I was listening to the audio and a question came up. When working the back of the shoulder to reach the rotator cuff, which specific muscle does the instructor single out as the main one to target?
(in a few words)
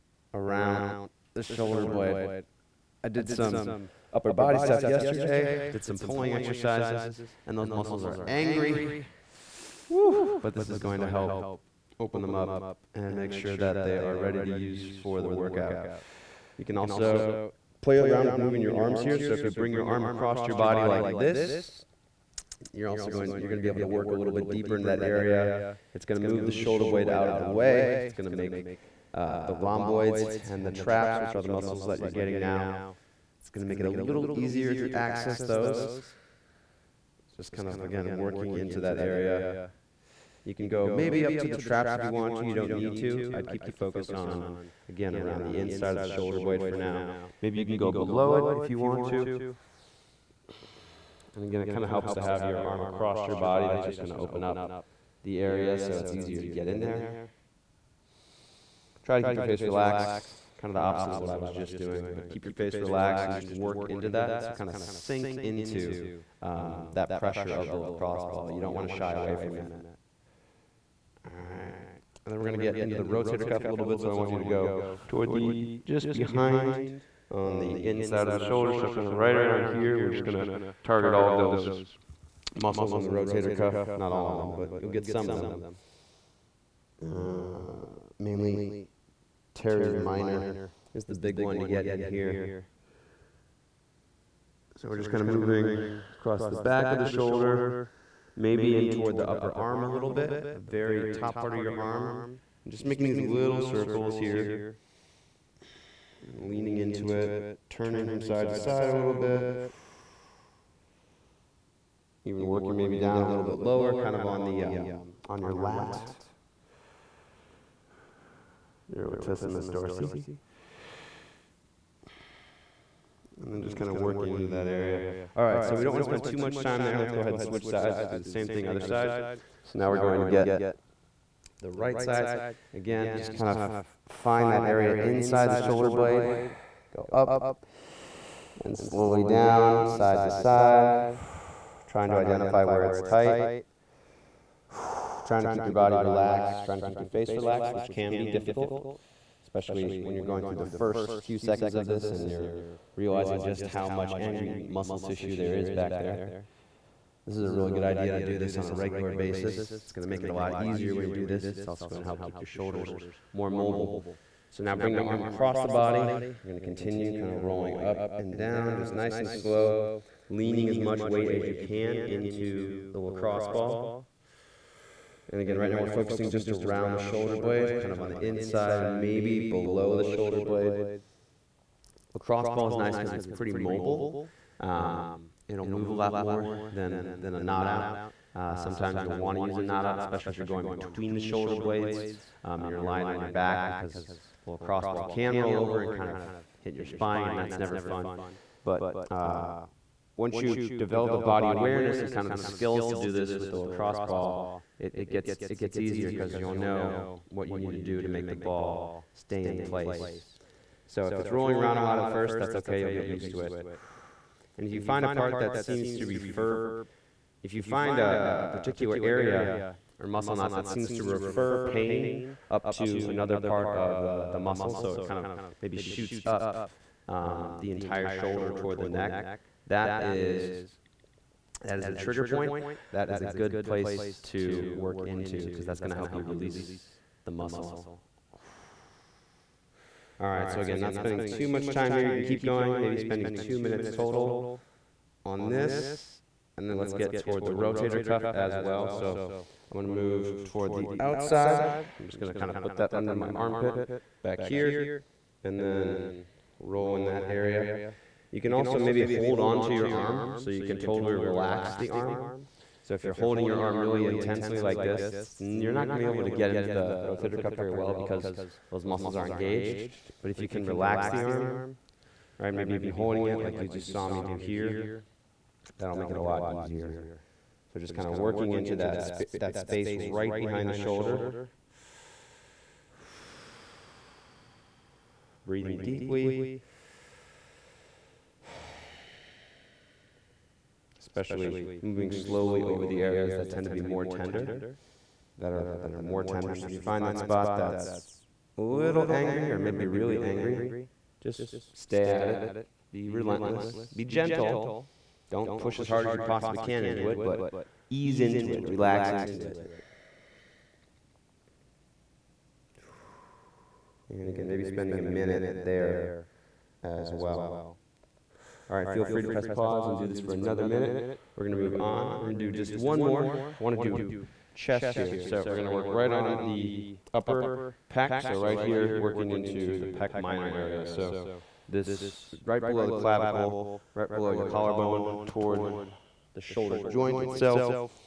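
teres minor.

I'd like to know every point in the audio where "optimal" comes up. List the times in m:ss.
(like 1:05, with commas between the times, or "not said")
not said.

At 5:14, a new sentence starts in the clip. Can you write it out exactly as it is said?
And again, maybe spending a minute there as well.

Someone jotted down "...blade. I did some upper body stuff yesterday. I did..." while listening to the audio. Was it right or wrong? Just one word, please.
right.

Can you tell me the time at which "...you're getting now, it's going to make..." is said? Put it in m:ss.
0:31.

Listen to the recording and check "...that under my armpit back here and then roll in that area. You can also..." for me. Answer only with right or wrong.
right.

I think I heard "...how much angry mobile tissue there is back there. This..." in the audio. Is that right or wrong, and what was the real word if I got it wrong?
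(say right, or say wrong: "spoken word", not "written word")
wrong: "muscle", not "mobile".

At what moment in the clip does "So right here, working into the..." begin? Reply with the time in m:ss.
5:28.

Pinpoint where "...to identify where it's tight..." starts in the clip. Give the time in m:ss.
2:22.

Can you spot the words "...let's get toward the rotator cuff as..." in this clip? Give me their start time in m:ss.
4:06.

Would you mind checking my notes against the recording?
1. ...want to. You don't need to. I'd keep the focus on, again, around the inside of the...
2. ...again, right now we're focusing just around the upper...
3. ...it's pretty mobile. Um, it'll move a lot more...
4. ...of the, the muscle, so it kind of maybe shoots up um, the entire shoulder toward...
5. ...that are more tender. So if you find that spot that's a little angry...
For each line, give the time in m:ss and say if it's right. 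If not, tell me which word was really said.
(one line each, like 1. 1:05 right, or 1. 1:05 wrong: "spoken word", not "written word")
1. 0:42 right
2. 2:55 wrong: "shoulder", not "upper"
3. 3:03 right
4. 3:43 right
5. 4:55 right.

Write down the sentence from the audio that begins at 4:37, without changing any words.
So just kind of working into that, sp that space right behind the shoulder.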